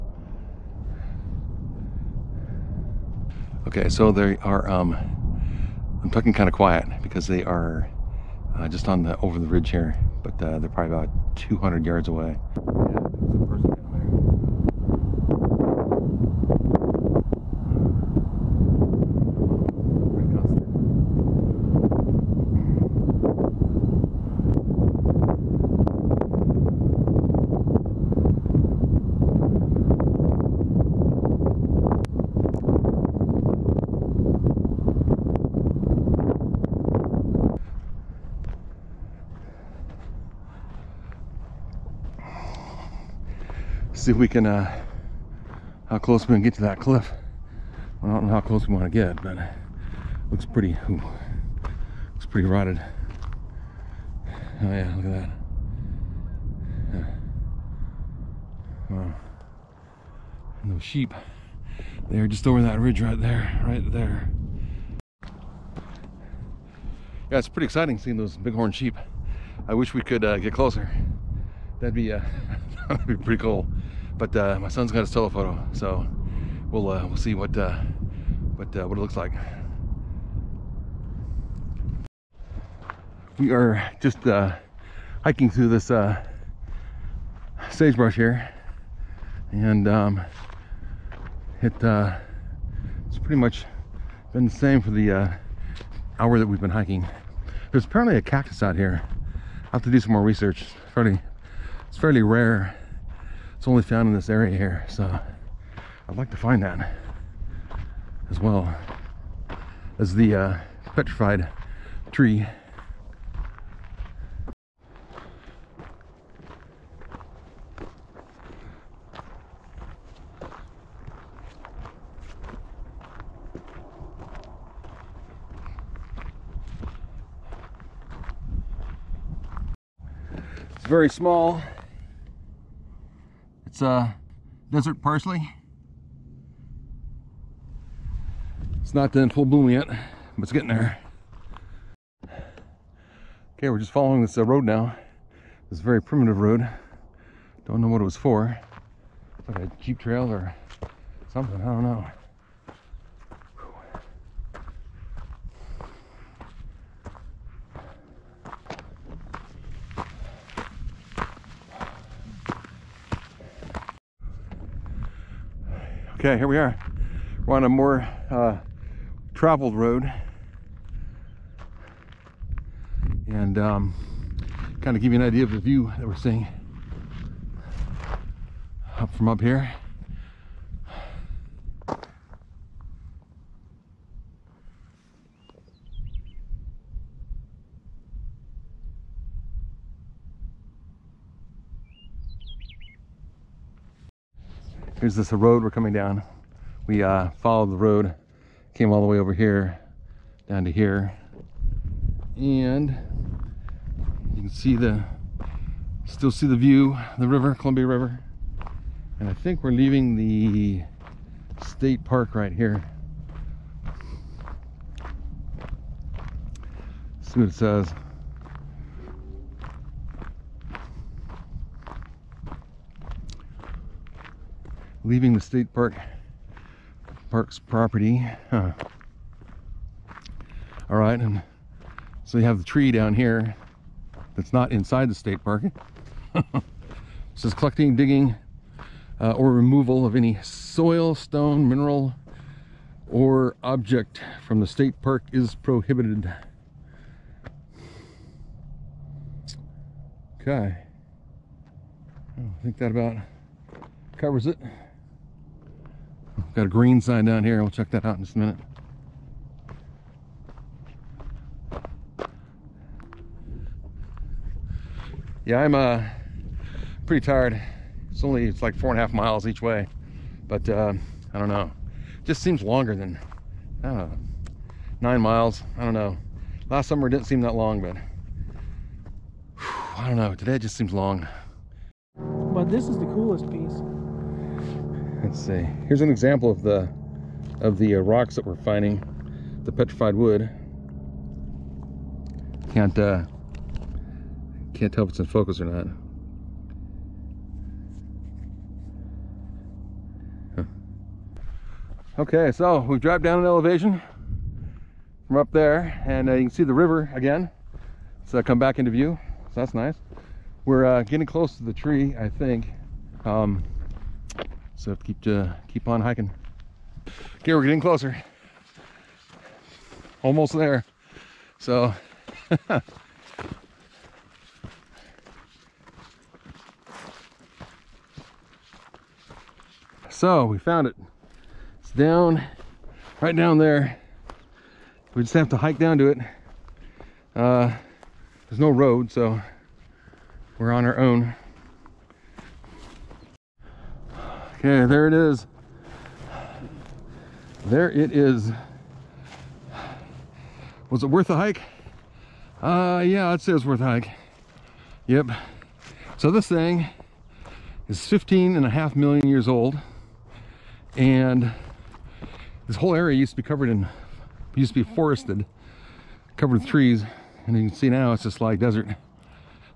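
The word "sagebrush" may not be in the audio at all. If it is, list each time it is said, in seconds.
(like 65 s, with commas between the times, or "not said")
87 s.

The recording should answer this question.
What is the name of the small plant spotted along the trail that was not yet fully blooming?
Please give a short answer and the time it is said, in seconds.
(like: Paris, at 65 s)
desert parsley, at 134 s.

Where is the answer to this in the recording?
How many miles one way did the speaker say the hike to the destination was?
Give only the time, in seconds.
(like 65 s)
268 s.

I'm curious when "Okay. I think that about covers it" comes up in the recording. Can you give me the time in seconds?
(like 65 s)
250 s.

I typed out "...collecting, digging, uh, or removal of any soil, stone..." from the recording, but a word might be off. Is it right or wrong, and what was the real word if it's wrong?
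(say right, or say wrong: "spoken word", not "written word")
right.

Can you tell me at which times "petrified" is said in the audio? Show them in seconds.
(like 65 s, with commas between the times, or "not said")
110 s, 289 s.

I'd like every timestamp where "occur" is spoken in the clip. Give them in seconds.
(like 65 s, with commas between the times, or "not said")
not said.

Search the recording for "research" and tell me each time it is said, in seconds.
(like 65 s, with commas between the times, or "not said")
100 s.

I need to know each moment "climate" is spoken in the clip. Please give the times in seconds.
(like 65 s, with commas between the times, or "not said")
not said.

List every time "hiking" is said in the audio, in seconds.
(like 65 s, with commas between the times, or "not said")
85 s, 96 s, 316 s.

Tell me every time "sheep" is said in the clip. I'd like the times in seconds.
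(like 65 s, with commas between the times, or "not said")
60 s, 68 s.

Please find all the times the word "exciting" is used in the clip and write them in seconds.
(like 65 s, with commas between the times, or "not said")
67 s.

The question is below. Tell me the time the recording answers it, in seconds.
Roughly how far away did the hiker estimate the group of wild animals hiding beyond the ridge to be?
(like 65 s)
11 s.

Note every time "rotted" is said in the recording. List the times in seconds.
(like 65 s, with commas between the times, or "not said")
52 s.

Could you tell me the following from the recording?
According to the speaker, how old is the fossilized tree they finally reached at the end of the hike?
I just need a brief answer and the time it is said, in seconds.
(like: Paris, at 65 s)
15.5 million years, at 358 s.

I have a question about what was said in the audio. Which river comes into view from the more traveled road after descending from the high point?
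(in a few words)
Columbia River.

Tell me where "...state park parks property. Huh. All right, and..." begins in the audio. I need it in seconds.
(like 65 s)
225 s.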